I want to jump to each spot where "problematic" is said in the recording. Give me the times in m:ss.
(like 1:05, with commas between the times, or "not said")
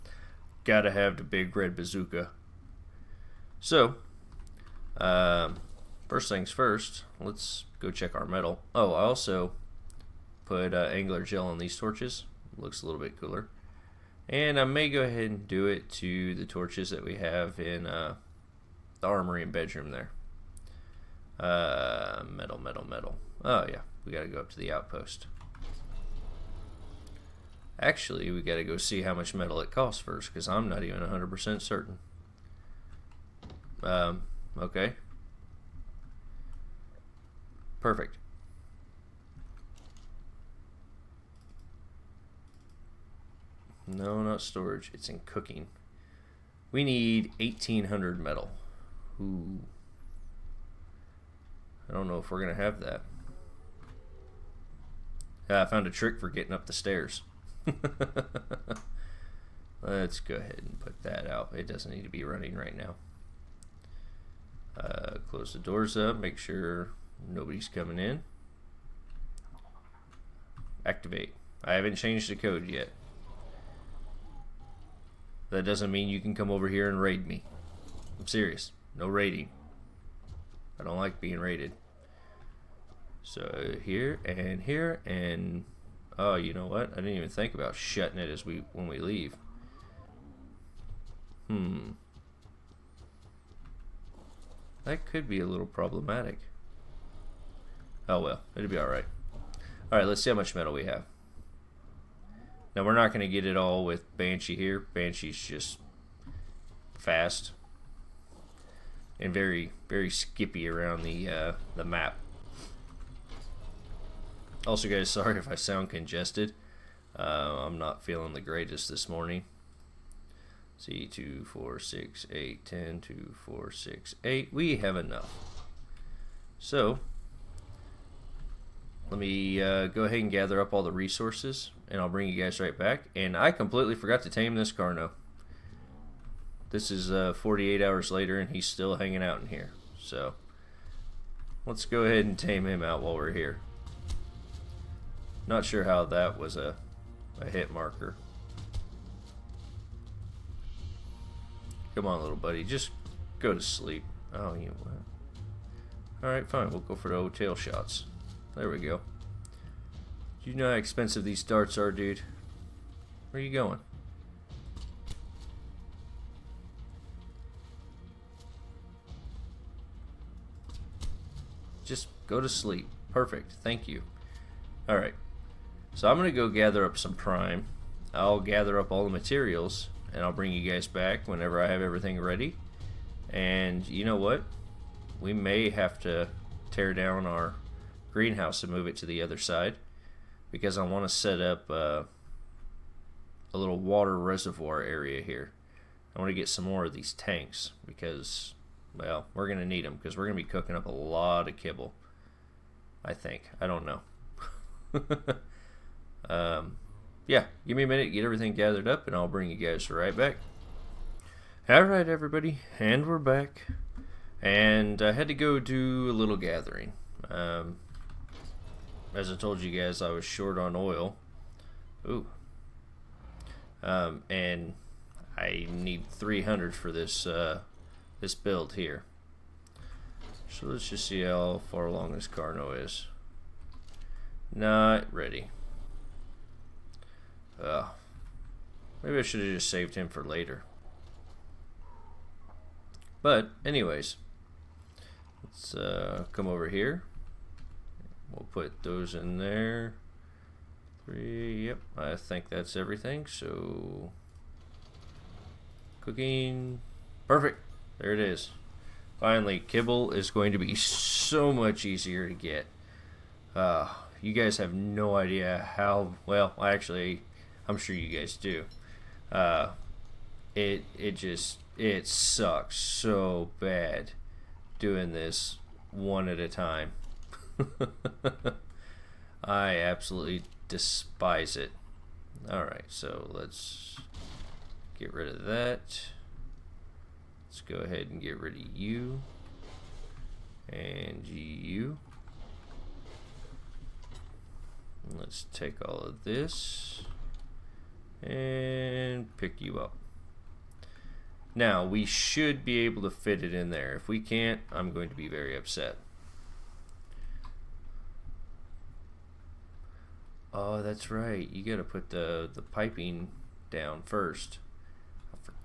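1:35.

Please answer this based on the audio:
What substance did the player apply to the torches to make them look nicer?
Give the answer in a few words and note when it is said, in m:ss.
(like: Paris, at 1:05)
angler gel, at 0:10.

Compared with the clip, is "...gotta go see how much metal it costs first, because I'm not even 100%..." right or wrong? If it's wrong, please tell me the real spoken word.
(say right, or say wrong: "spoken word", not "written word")
right.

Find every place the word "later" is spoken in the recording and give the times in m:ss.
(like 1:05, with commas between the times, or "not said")
2:18, 4:00.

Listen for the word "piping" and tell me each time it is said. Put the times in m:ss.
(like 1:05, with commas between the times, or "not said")
5:12.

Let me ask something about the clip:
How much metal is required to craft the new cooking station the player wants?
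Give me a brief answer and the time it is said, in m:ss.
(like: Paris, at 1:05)
1,800, at 0:47.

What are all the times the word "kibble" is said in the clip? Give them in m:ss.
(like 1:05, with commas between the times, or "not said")
3:21, 4:19.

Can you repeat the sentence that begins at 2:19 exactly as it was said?
So, let's go ahead and tame him out while we're here.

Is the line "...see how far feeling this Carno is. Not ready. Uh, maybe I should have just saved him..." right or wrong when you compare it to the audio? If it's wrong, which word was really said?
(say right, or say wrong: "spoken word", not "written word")
wrong: "along", not "feeling".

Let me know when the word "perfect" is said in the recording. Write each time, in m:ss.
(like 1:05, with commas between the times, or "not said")
0:37, 2:53, 4:17.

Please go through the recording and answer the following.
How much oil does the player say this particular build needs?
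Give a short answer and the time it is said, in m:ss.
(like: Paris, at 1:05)
300, at 3:46.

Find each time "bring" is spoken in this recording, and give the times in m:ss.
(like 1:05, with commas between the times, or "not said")
2:12, 3:00, 3:29.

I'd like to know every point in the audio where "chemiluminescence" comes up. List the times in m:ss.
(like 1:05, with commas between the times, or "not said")
not said.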